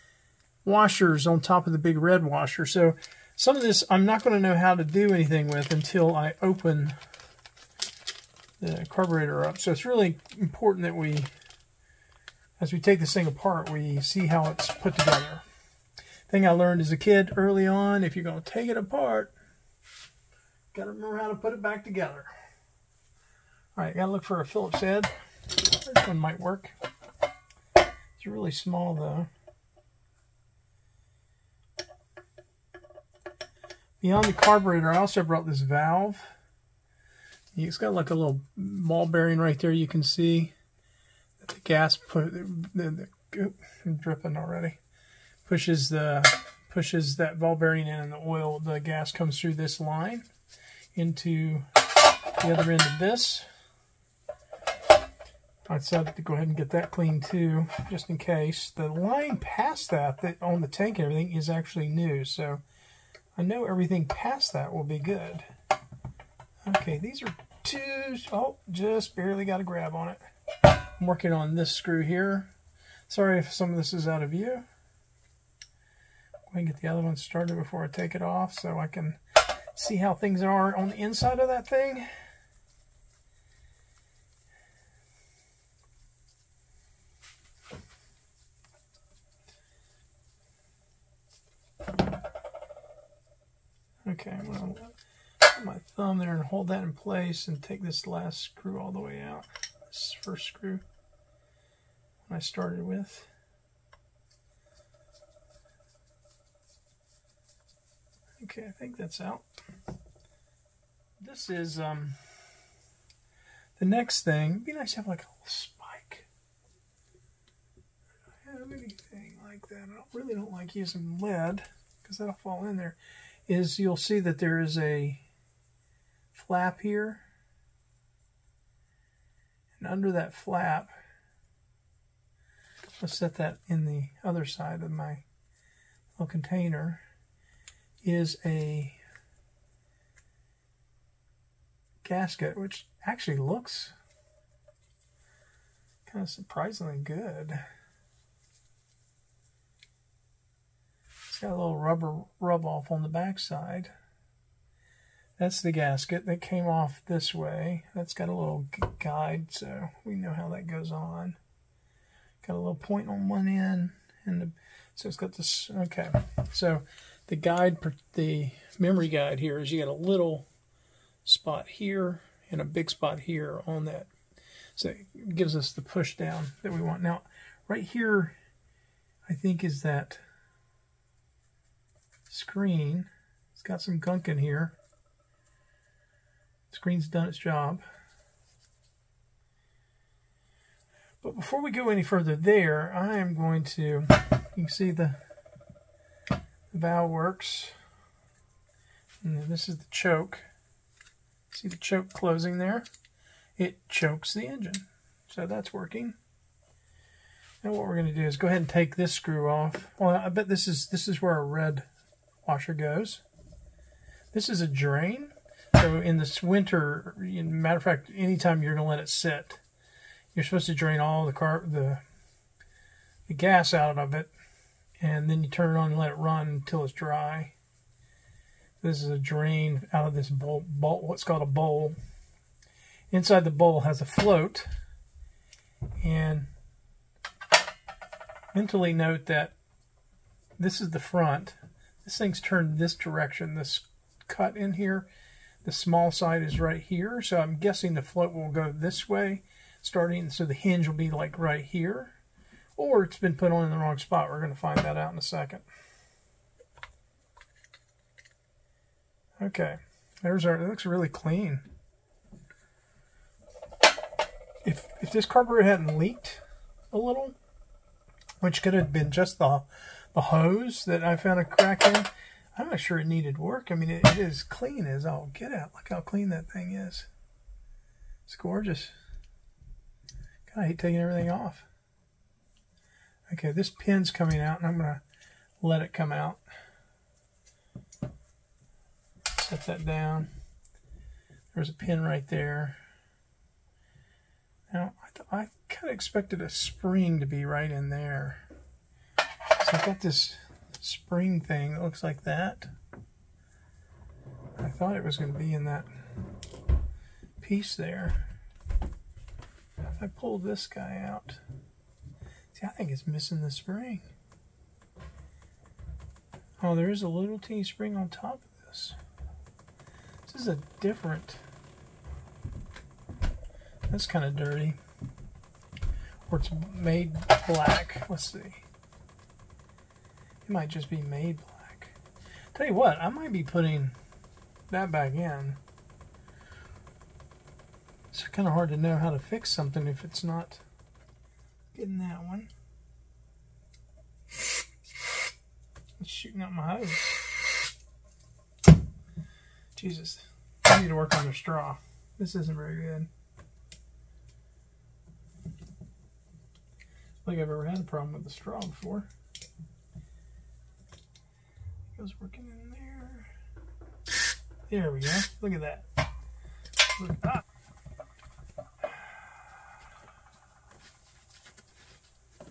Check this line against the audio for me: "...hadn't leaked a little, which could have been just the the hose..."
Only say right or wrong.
right.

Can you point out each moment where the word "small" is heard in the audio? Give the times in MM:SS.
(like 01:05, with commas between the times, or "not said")
00:28, 04:05.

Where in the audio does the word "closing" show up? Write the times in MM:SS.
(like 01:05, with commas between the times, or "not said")
03:22.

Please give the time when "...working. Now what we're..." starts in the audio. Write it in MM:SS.
03:25.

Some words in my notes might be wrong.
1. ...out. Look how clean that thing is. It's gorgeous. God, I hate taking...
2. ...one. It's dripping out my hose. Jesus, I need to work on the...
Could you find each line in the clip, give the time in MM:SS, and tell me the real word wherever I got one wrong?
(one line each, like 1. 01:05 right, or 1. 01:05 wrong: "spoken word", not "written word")
1. 04:35 right
2. 05:42 wrong: "shooting", not "dripping".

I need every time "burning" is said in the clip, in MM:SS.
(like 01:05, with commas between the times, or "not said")
not said.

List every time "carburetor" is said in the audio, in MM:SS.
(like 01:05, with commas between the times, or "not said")
00:08, 00:34, 04:25.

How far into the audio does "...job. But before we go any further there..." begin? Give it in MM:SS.
03:07.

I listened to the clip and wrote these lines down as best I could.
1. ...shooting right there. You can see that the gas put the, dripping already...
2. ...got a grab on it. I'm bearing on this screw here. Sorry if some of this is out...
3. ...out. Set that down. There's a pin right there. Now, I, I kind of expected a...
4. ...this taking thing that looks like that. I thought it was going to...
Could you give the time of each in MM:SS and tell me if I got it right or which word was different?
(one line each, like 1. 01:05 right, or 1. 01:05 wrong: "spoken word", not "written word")
1. 00:39 wrong: "bearing", not "shooting"
2. 01:09 wrong: "working", not "bearing"
3. 04:46 right
4. 05:00 wrong: "spring", not "taking".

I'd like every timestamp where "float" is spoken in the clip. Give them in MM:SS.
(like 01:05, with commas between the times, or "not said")
03:54, 04:08.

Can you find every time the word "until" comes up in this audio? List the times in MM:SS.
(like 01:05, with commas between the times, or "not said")
00:05, 03:46.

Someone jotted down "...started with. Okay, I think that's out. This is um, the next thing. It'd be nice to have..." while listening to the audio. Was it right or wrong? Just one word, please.
right.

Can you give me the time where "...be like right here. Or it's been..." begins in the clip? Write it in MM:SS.
04:10.